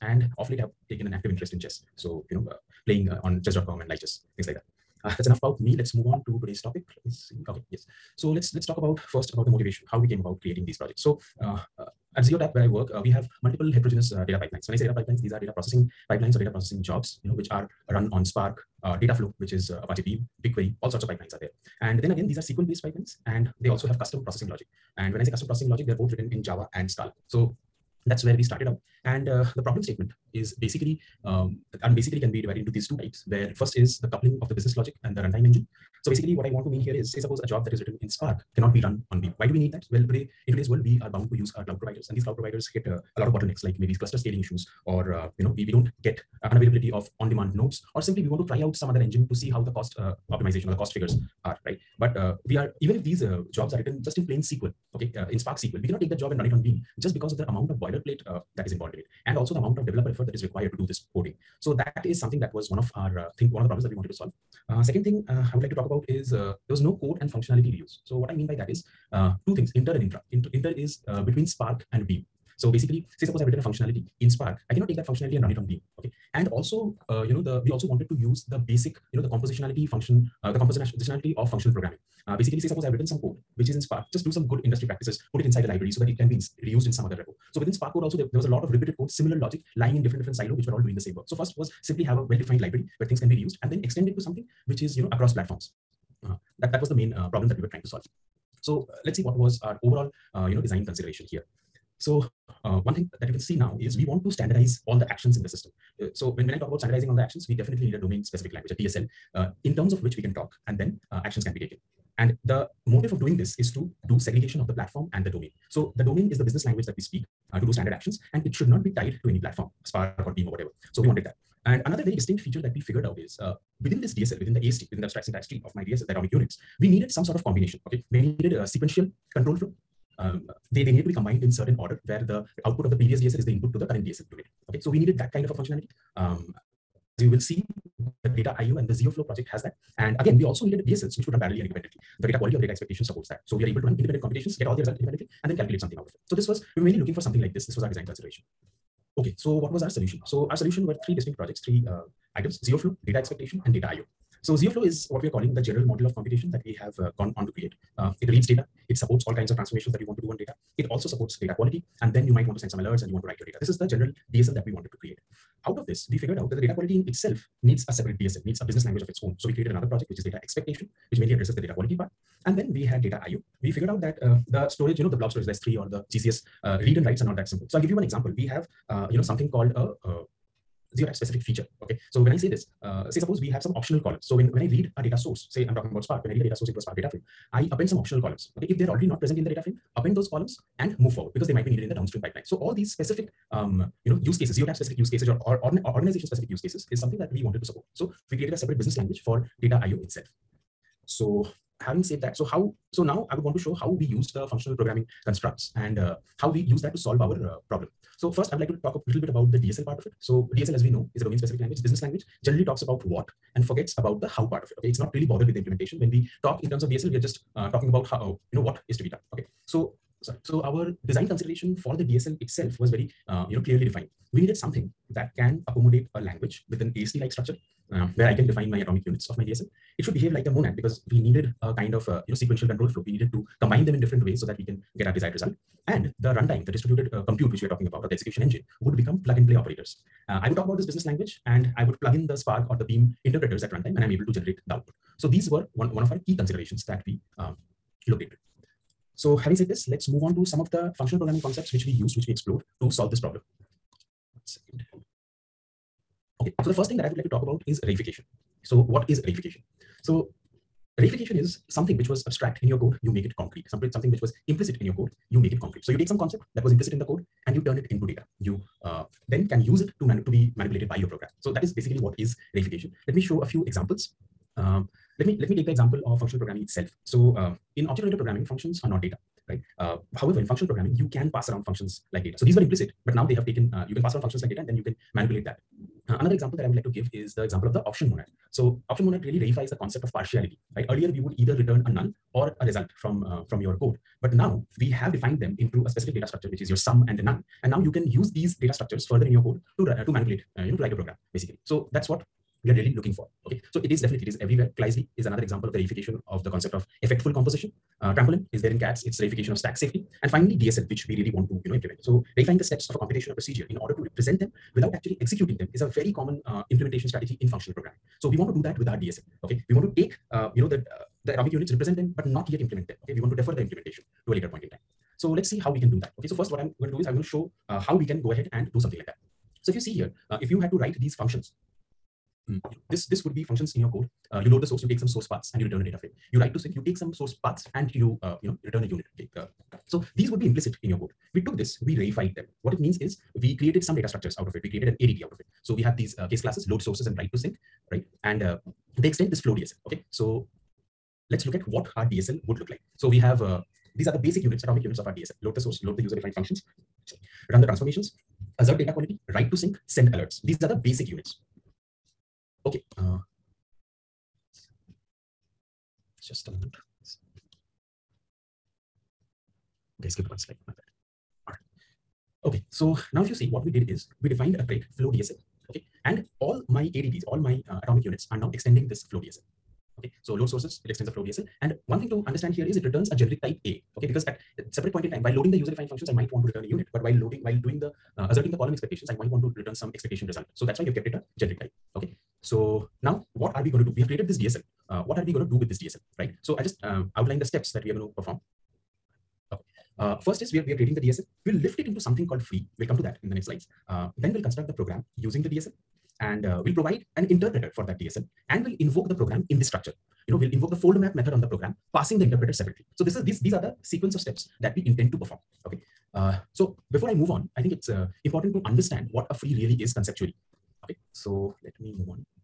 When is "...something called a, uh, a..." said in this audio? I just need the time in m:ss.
2:59.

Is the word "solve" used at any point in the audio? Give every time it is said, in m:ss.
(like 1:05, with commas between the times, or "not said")
1:04, 1:37, 3:26, 4:12.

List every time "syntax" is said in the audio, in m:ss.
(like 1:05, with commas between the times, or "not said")
2:05.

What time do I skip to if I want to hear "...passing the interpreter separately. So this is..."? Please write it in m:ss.
6:51.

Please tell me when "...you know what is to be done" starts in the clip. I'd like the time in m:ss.
3:38.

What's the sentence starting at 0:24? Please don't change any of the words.
And when I say custom processing logic, they're both written in Java and Scala.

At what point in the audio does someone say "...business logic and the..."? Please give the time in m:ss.
0:34.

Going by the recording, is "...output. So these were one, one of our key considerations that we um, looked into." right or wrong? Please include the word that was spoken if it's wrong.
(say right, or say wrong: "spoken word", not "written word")
right.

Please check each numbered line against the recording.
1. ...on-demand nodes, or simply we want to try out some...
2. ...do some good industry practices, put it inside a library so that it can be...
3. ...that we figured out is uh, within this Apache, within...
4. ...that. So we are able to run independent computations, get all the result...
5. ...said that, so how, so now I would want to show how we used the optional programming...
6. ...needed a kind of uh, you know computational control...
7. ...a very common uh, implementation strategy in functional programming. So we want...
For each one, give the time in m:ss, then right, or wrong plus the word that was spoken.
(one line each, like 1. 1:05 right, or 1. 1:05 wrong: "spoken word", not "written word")
1. 0:47 right
2. 1:24 right
3. 2:02 wrong: "DSL", not "Apache"
4. 2:23 right
5. 3:22 wrong: "functional", not "optional"
6. 3:51 wrong: "sequential", not "computational"
7. 5:15 right.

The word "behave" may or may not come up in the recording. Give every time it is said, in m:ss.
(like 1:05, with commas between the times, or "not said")
3:50.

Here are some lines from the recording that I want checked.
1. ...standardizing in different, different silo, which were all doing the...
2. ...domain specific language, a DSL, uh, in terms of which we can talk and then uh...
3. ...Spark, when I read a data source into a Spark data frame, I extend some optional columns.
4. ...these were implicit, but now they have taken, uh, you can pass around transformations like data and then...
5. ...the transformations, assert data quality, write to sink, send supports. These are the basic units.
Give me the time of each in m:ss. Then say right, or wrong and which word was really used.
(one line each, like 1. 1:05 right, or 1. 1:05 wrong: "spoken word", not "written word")
1. 1:29 wrong: "lying", not "standardizing"
2. 1:47 right
3. 3:06 wrong: "append", not "extend"
4. 4:42 wrong: "functions", not "transformations"
5. 5:57 wrong: "alerts", not "supports".